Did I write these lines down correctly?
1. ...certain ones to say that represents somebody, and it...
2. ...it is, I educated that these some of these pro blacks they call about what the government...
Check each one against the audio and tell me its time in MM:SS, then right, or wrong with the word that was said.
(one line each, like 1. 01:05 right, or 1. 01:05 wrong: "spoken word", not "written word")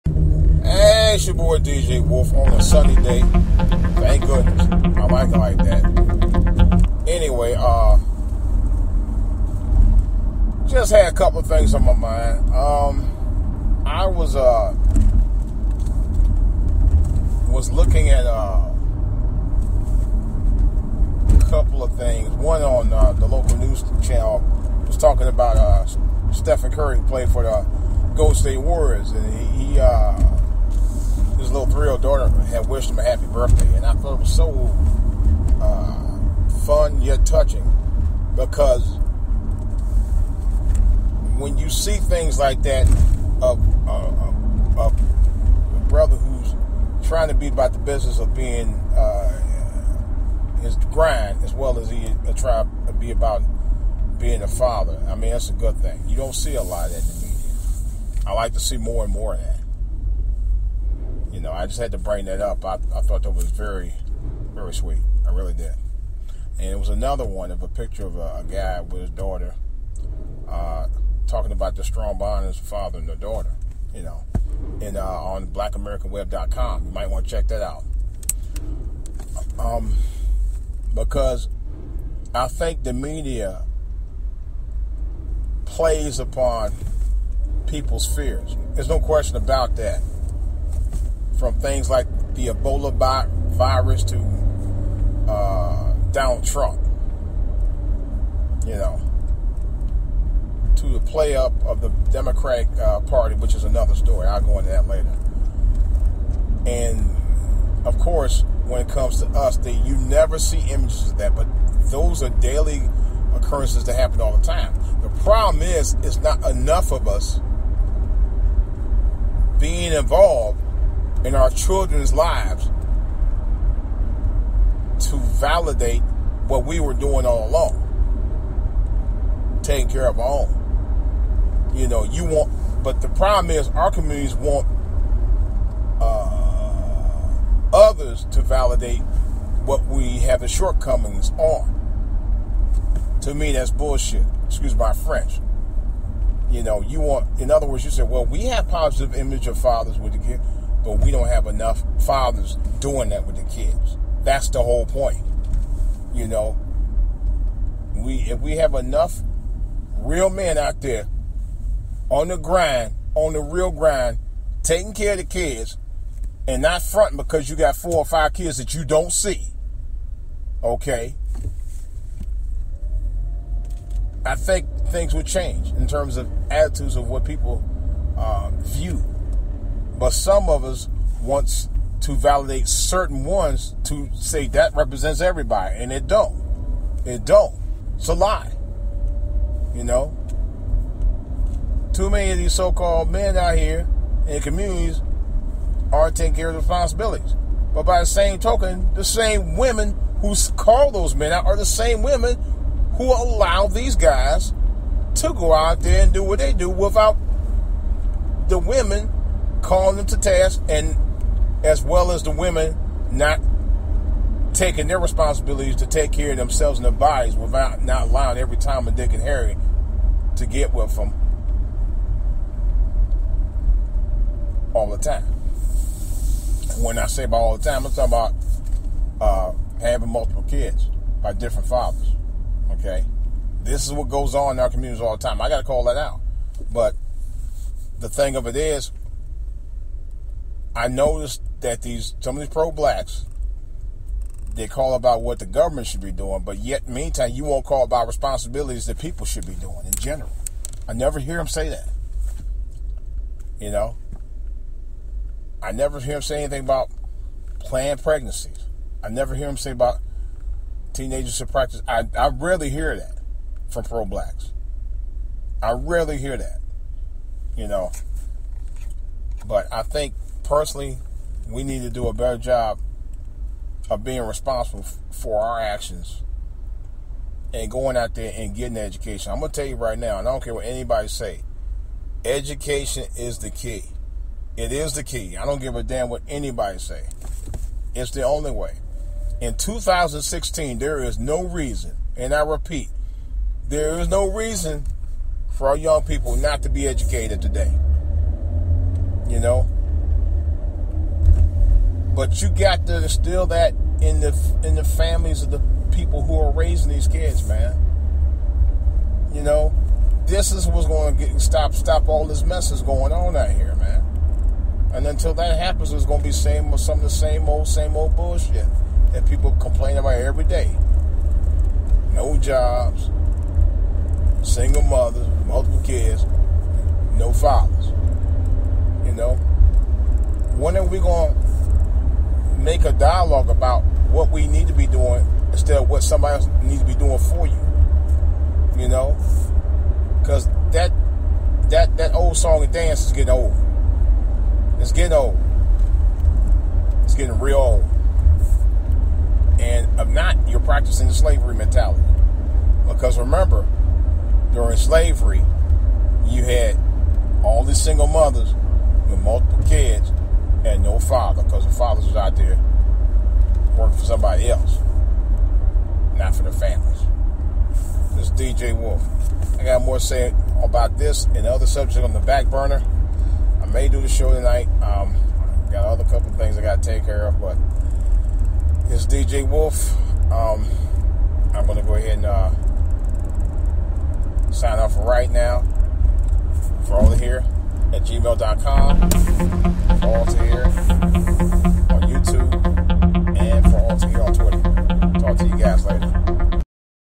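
1. 03:02 wrong: "everybody", not "somebody"
2. 03:58 wrong: "noticed", not "educated".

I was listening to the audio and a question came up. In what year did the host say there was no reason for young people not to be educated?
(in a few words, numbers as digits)
2016.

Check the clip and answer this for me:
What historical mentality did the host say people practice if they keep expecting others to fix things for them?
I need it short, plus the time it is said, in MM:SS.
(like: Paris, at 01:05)
slavery mentality, at 05:51.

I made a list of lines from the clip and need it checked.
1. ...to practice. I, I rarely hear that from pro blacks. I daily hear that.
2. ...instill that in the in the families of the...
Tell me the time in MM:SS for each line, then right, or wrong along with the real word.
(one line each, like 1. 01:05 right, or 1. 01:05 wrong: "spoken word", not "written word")
1. 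04:21 wrong: "rarely", not "daily"
2. 05:03 right.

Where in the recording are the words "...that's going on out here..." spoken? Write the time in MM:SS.
05:12.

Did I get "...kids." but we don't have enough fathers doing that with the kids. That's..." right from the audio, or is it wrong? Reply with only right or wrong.
right.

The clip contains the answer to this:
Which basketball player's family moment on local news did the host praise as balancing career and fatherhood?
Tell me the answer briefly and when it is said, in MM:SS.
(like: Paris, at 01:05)
Stephen Curry, at 00:26.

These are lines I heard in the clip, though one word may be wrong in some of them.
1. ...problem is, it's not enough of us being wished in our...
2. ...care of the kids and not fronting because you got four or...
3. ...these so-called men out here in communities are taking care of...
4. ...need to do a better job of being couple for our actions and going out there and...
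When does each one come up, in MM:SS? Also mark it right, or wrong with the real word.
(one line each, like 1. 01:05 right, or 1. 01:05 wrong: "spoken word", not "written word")
1. 01:55 wrong: "involved", not "wished"
2. 02:44 right
3. 03:12 right
4. 04:31 wrong: "responsible", not "couple".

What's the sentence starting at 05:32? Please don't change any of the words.
make a dialogue about what we need to be doing instead of what somebody else needs to be doing for you.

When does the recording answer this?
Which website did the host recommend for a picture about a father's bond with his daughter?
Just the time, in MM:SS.
01:15.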